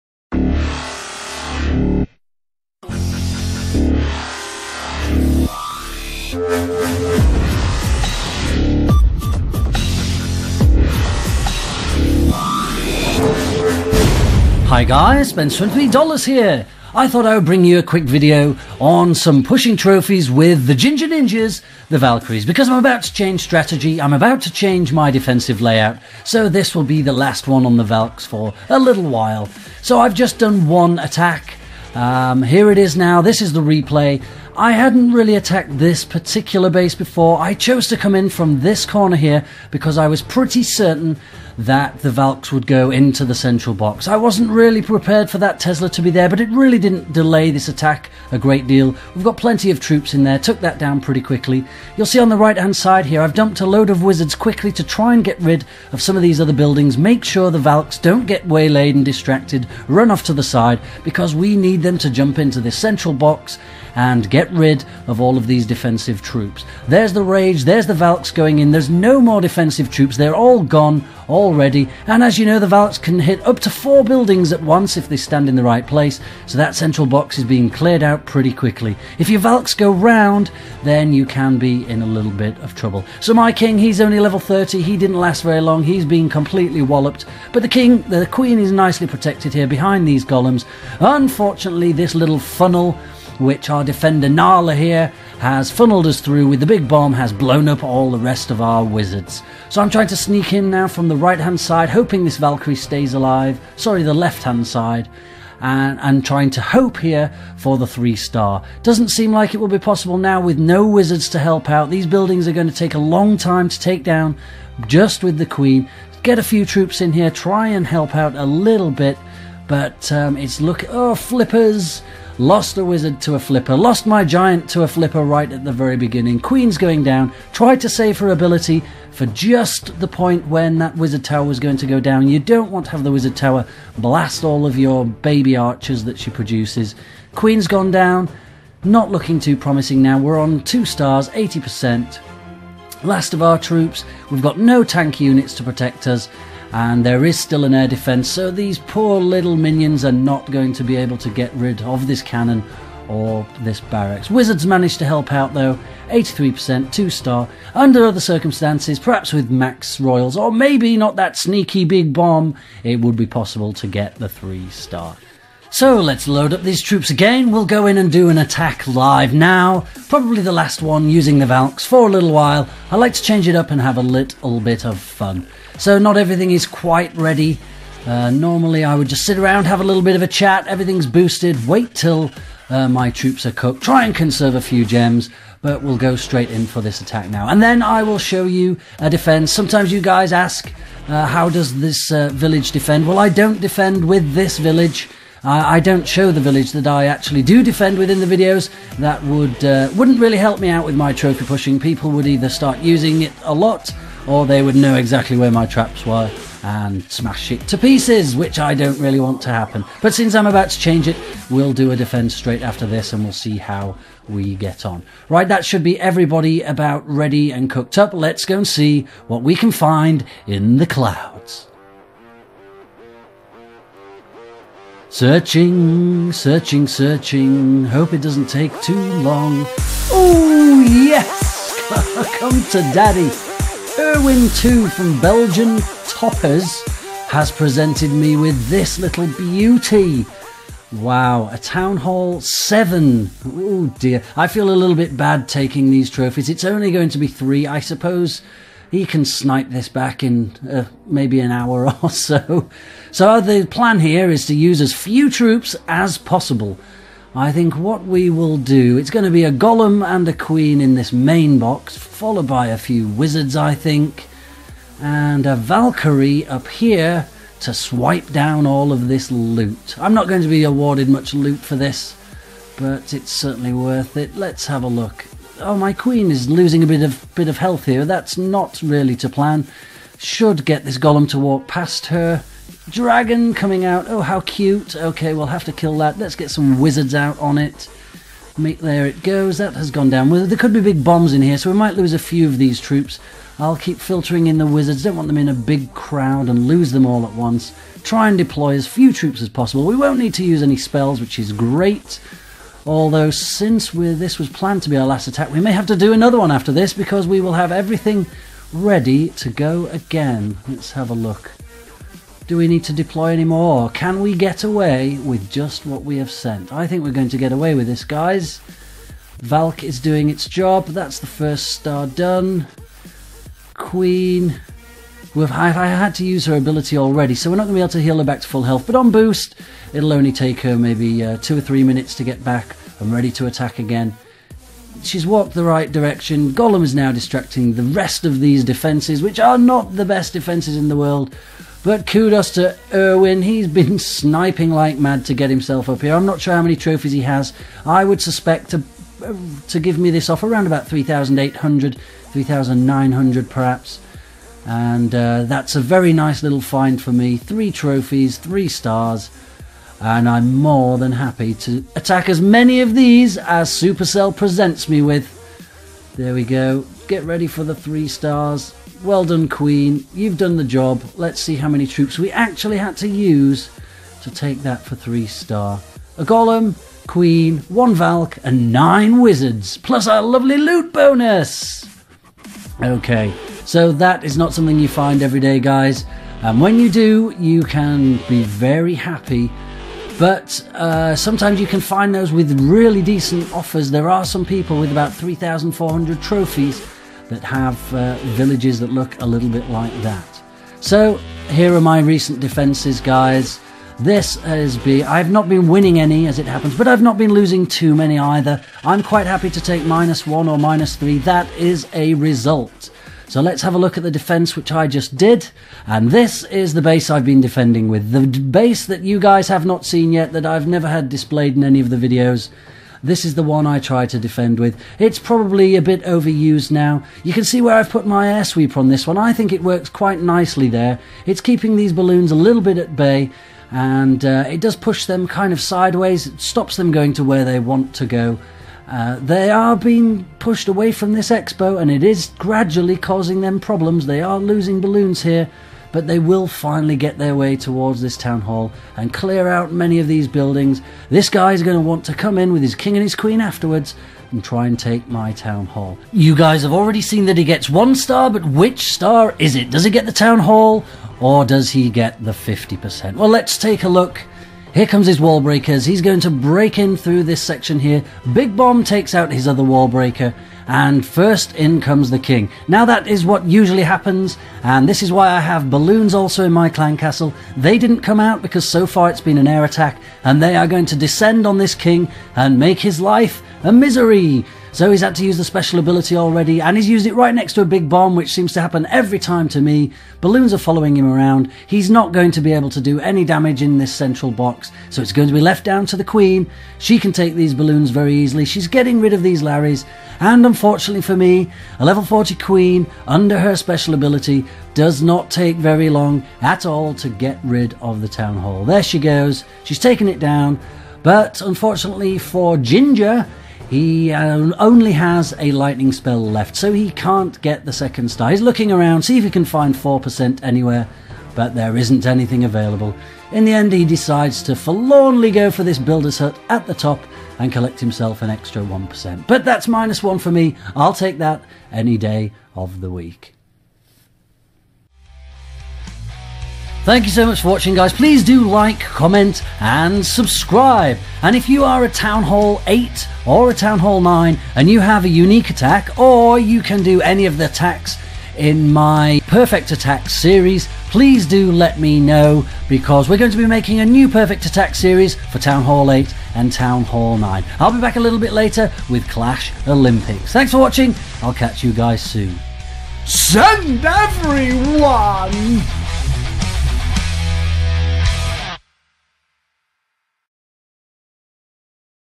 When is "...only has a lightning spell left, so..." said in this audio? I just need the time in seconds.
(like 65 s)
514 s.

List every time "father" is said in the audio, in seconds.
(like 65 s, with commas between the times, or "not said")
not said.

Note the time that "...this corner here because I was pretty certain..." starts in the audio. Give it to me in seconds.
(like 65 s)
38 s.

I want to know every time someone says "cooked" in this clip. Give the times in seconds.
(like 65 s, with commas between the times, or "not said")
183 s, 217 s.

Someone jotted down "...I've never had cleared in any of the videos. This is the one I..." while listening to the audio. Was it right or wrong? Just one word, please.
wrong.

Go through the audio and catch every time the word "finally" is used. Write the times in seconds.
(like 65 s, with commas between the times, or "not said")
446 s.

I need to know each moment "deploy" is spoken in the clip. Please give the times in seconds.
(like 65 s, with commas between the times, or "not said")
298 s, 312 s.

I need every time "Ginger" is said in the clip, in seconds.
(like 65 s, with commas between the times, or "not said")
20 s, 512 s.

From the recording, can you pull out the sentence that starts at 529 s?
But that's minus one for me.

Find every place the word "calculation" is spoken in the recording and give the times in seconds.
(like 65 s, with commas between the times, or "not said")
not said.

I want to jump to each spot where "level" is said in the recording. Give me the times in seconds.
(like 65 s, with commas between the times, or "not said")
84 s, 501 s.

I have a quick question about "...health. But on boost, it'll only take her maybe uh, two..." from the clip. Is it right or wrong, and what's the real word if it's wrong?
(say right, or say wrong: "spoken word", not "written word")
right.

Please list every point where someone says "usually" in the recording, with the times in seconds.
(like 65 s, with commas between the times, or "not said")
473 s.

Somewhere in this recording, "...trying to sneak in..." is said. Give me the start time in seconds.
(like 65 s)
99 s.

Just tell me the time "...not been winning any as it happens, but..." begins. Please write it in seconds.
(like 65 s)
405 s.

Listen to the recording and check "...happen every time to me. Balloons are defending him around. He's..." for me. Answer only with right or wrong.
wrong.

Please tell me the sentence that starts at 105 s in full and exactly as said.
And, and, trying to hope here for the three star.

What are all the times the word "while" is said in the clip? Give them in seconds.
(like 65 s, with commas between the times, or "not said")
29 s, 172 s.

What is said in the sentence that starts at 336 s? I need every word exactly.
Golem is now distracting the rest of these defences, which are not the best defences in the world.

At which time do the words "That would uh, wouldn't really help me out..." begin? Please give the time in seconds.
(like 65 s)
198 s.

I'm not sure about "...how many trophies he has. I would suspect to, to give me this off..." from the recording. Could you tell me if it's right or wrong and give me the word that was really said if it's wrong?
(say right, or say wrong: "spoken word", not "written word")
right.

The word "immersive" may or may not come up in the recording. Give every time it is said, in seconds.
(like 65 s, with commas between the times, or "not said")
not said.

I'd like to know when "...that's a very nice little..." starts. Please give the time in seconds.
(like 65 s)
355 s.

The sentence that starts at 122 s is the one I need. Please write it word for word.
Lost the wizard to a flipper, lost my giant to a flipper right at the very beginning.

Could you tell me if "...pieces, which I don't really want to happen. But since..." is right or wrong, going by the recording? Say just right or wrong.
right.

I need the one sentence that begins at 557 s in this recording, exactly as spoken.
I'll be back a little bit later with Clash Olympics.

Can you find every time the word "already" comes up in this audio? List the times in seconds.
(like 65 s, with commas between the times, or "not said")
71 s, 326 s, 456 s, 486 s.